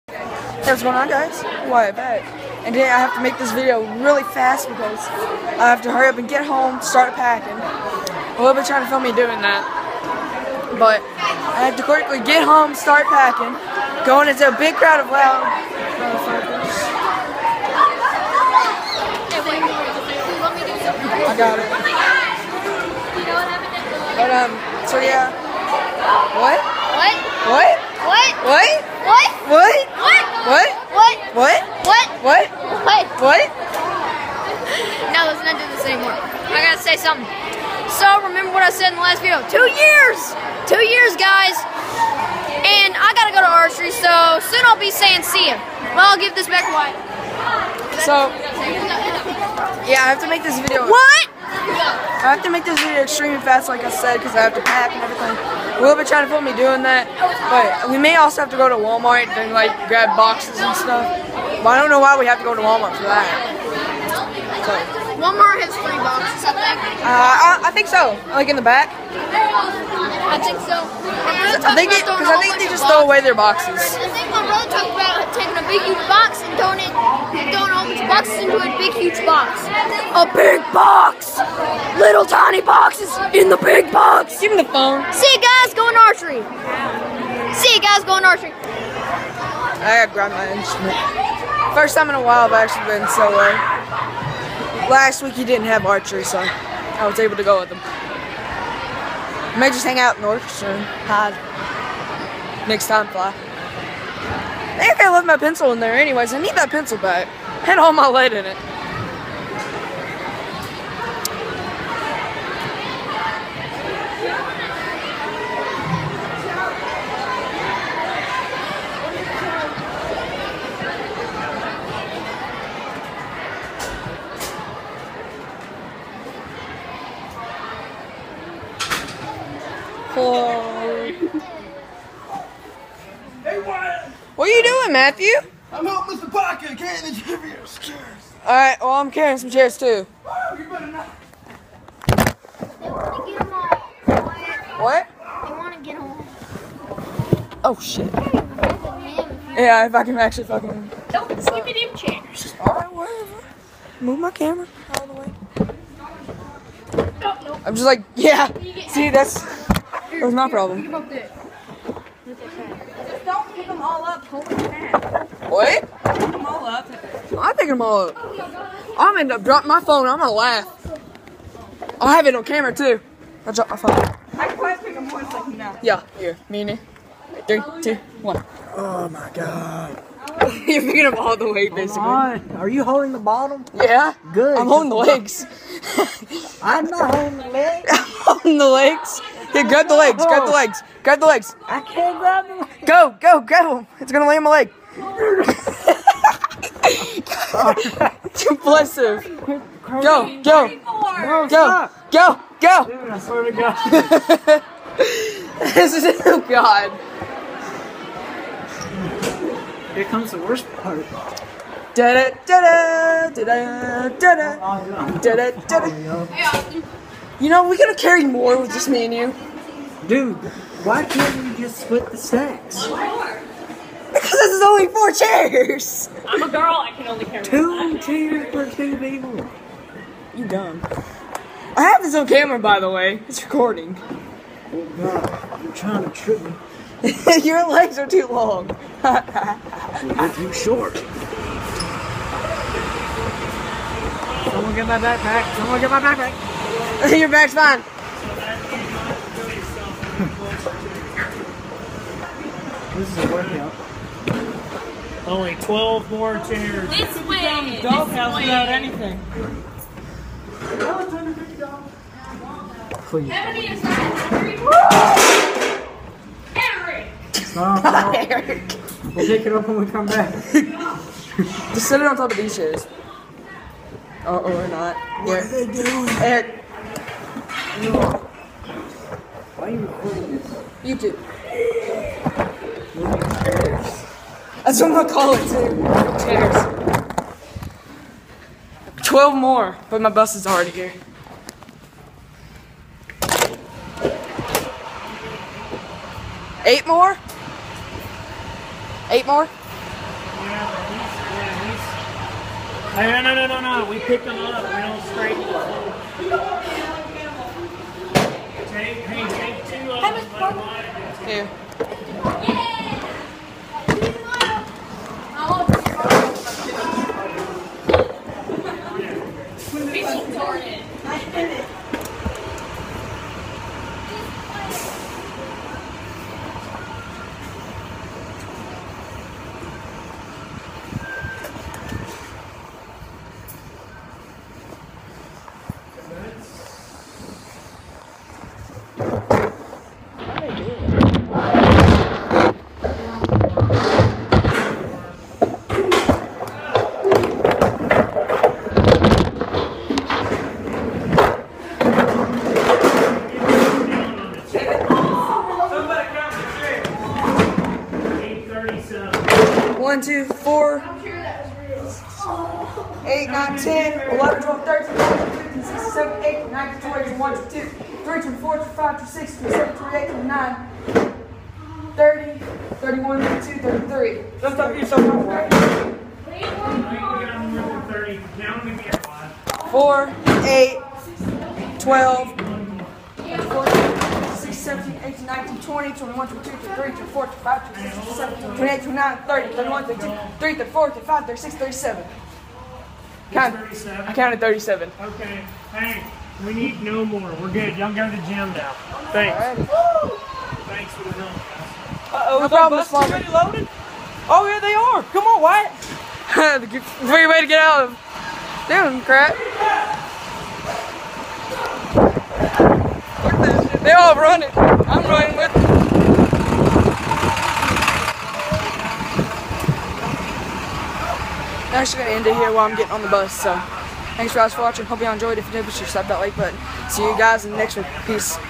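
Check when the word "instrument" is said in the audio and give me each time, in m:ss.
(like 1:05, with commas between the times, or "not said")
1:30.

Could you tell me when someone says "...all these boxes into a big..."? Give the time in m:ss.
1:17.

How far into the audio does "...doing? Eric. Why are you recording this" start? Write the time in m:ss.
4:35.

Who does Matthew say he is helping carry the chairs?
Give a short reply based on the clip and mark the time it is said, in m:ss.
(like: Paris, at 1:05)
Mr. Pocket, at 2:16.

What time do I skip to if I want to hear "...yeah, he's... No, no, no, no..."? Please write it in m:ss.
5:03.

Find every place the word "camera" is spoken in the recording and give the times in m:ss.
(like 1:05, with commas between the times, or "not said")
2:34, 2:52, 3:52.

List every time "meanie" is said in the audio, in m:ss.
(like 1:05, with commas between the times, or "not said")
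2:56.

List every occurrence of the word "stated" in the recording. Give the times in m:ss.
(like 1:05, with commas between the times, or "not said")
not said.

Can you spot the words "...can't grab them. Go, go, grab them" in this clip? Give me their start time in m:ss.
3:11.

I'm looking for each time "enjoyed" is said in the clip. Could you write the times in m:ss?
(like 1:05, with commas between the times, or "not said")
7:05.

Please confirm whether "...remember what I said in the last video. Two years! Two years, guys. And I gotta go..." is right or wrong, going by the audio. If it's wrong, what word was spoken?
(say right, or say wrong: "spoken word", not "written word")
right.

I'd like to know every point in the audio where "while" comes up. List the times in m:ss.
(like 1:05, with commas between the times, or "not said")
1:32, 7:02.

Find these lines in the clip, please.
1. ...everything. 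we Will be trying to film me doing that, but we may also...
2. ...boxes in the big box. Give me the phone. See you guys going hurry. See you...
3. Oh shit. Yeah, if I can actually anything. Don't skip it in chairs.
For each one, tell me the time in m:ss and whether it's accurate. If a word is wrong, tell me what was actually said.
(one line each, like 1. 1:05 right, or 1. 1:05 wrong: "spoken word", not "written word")
1. 0:55 right
2. 1:22 wrong: "archery", not "hurry"
3. 2:27 wrong: "fucking", not "anything".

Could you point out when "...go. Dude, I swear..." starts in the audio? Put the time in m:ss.
3:22.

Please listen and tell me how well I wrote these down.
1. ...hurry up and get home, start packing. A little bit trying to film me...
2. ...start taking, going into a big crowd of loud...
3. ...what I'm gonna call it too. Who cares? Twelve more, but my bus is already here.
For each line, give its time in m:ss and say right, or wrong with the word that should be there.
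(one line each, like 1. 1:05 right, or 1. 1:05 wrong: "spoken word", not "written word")
1. 0:05 right
2. 0:12 wrong: "packing", not "taking"
3. 4:44 right.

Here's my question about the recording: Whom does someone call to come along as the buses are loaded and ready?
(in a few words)
Wyatt.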